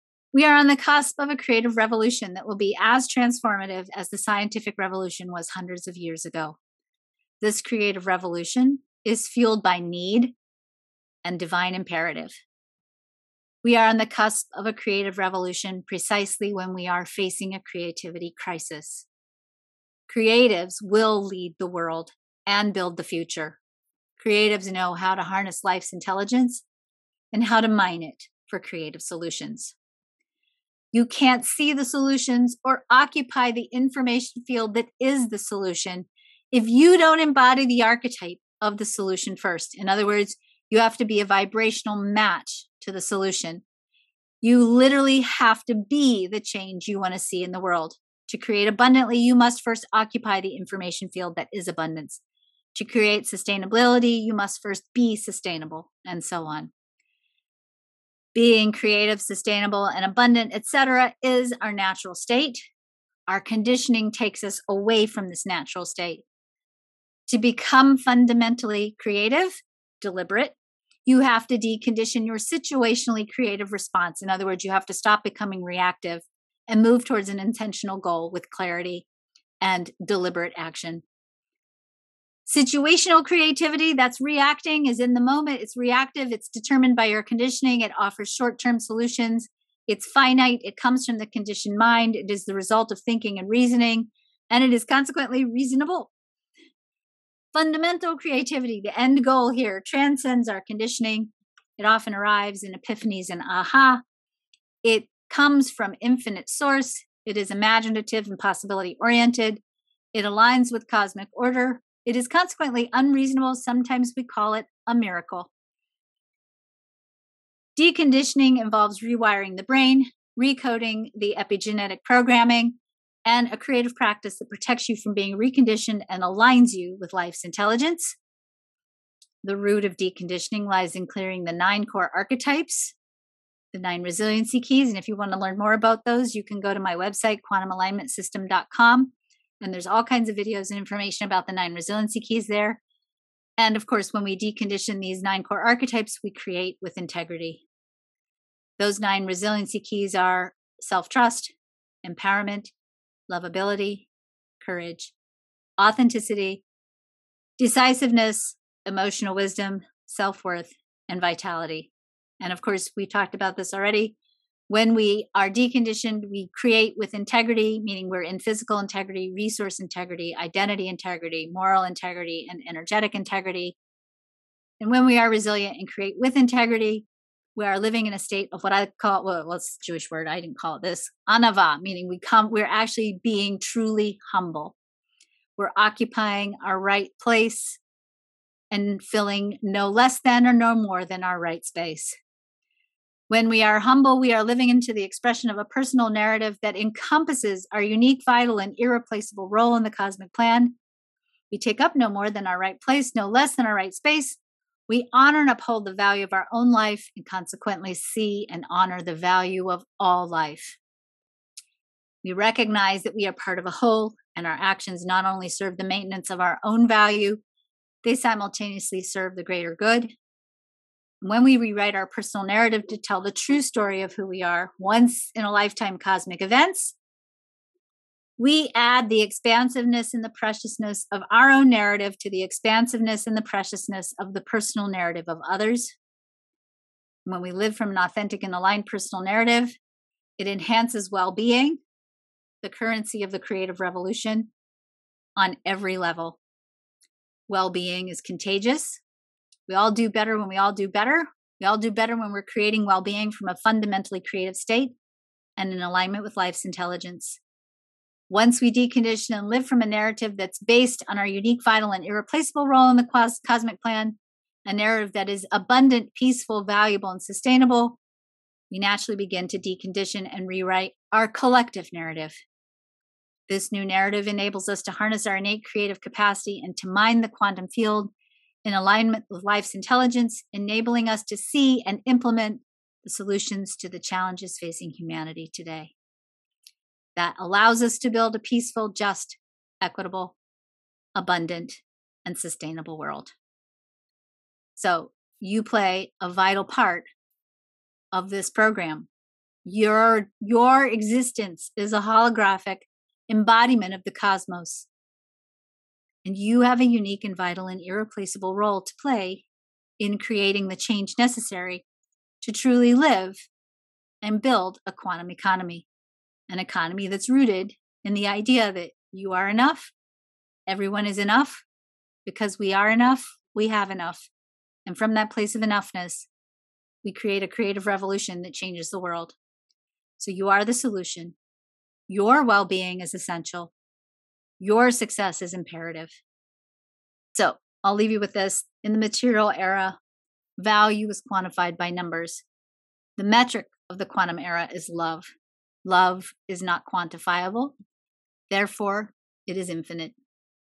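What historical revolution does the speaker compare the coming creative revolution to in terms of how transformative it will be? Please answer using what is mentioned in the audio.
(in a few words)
scientific revolution.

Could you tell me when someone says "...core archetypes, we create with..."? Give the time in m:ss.
2:25.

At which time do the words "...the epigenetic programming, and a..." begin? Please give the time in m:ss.
2:01.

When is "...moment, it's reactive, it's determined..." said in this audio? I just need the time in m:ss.
1:25.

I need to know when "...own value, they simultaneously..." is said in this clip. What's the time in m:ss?
3:36.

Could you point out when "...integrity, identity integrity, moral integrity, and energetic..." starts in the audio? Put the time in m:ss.
2:49.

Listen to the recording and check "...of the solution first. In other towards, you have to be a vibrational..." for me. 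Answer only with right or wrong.
wrong.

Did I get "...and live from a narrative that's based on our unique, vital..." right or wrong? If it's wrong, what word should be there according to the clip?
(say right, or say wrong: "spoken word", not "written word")
right.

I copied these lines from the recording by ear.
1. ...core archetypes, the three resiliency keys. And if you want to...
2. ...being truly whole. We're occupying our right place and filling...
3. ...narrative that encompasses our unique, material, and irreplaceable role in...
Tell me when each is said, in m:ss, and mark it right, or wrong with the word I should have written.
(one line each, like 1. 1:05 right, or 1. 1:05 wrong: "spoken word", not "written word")
1. 2:11 wrong: "nine", not "three"
2. 3:03 wrong: "humble", not "whole"
3. 3:16 wrong: "vital", not "material".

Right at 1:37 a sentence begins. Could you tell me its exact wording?
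Fundamental creativity, the end goal here, transcends our conditioning.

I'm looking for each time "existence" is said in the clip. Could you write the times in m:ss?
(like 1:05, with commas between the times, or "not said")
5:00.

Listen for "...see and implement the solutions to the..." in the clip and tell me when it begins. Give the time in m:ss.
4:41.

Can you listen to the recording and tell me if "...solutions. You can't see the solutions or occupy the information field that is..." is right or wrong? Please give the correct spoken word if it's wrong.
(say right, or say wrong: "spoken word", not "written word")
right.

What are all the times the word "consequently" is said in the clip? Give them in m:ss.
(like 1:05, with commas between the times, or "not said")
1:34, 1:52, 3:27.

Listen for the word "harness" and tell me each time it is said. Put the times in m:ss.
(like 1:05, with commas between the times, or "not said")
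0:25, 4:34.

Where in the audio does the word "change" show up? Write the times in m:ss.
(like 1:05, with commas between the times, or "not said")
0:46, 5:10, 5:28.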